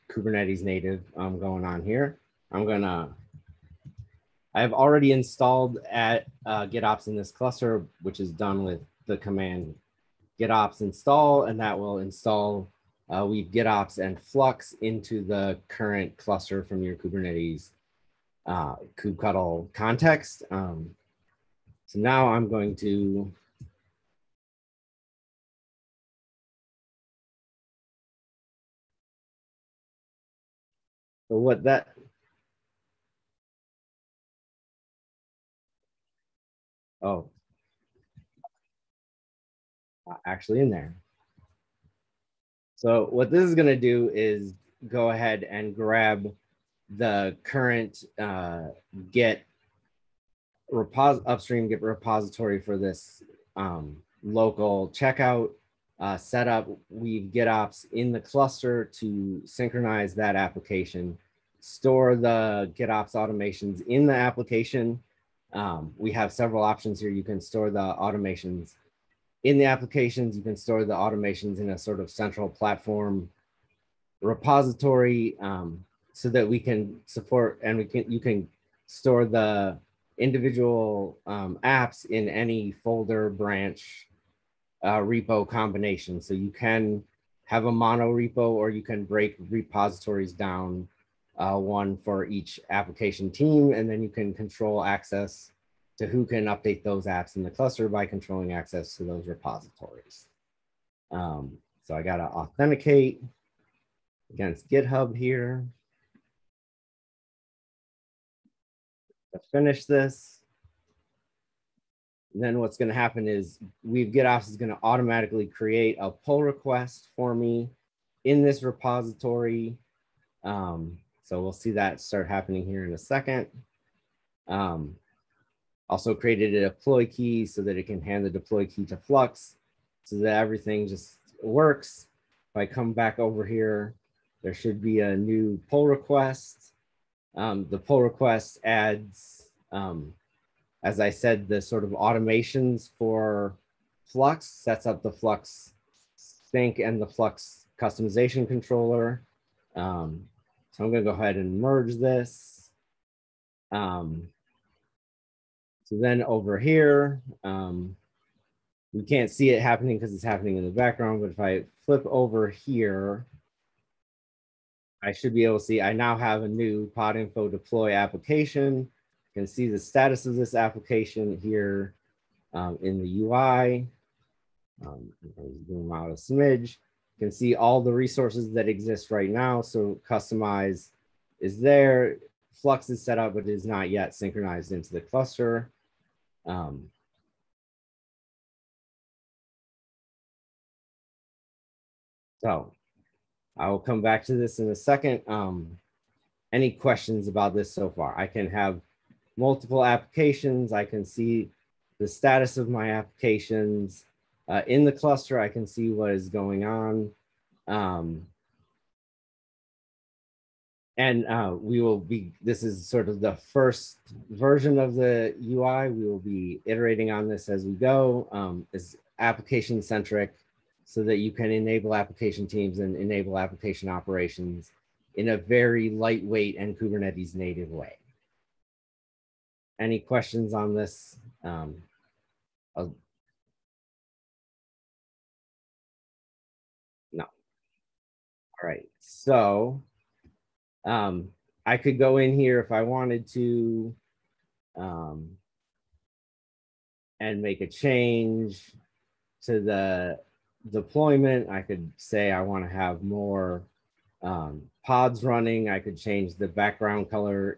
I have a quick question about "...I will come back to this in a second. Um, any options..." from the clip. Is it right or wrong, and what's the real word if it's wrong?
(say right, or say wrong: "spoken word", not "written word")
wrong: "questions", not "options".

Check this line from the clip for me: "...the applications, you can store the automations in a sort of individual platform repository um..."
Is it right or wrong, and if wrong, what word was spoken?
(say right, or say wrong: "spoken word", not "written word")
wrong: "central", not "individual".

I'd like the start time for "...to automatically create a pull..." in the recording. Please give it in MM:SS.
01:54.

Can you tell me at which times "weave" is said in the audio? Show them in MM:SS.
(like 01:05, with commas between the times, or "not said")
00:13, 00:56, 01:53.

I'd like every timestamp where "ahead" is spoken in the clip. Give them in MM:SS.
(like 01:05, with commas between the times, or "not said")
00:45, 02:31.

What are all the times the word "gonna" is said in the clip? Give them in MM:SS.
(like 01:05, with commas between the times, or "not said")
00:02, 02:30.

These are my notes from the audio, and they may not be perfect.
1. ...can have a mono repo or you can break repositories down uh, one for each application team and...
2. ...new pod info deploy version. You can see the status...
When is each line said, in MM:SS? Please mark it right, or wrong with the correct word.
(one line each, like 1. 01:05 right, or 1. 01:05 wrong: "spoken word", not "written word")
1. 01:26 right
2. 02:46 wrong: "application", not "version".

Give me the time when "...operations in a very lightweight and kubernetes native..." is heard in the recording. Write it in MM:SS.
03:43.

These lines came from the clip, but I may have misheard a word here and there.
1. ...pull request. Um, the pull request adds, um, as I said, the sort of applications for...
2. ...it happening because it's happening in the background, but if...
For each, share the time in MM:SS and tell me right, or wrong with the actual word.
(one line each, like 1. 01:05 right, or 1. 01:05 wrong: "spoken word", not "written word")
1. 02:15 wrong: "automations", not "applications"
2. 02:39 right.